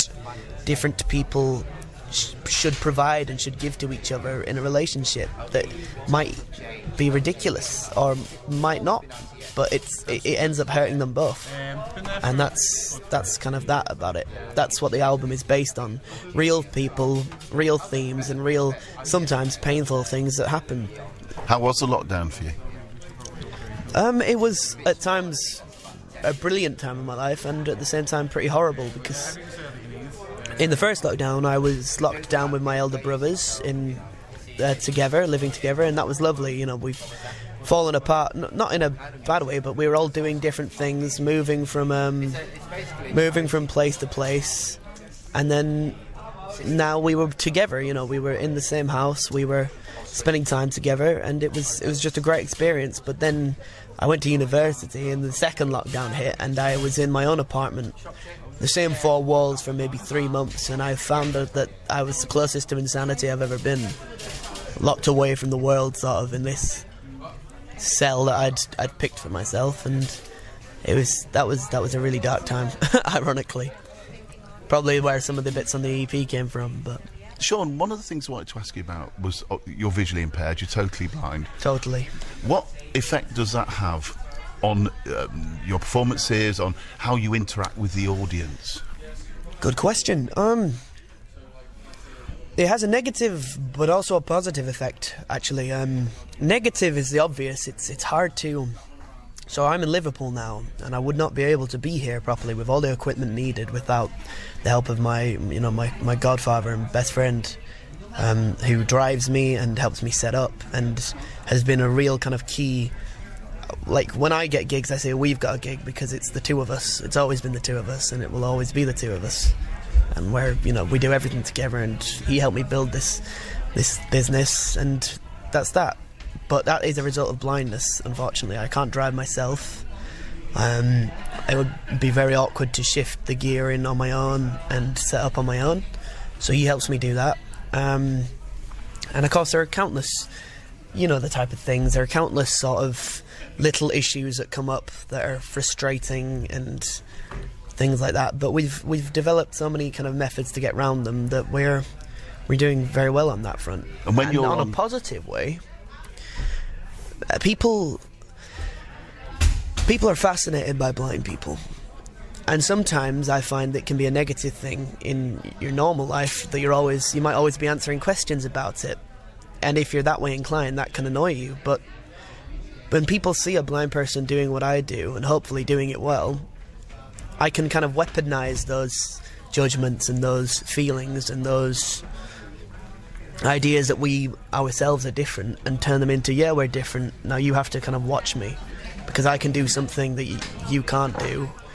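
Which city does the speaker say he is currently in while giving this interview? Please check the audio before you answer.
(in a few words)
Liverpool.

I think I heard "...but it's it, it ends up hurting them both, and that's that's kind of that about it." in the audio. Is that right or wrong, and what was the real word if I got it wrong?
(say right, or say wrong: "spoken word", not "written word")
right.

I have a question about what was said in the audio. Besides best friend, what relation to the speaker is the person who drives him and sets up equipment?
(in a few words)
Godfather.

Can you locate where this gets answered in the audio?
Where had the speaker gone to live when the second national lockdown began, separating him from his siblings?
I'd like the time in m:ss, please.
0:54.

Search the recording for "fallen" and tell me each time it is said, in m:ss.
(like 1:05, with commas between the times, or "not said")
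0:37.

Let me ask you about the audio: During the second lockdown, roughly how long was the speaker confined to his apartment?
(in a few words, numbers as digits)
3 months.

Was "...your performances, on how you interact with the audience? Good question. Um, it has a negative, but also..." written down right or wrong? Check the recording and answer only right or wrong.
right.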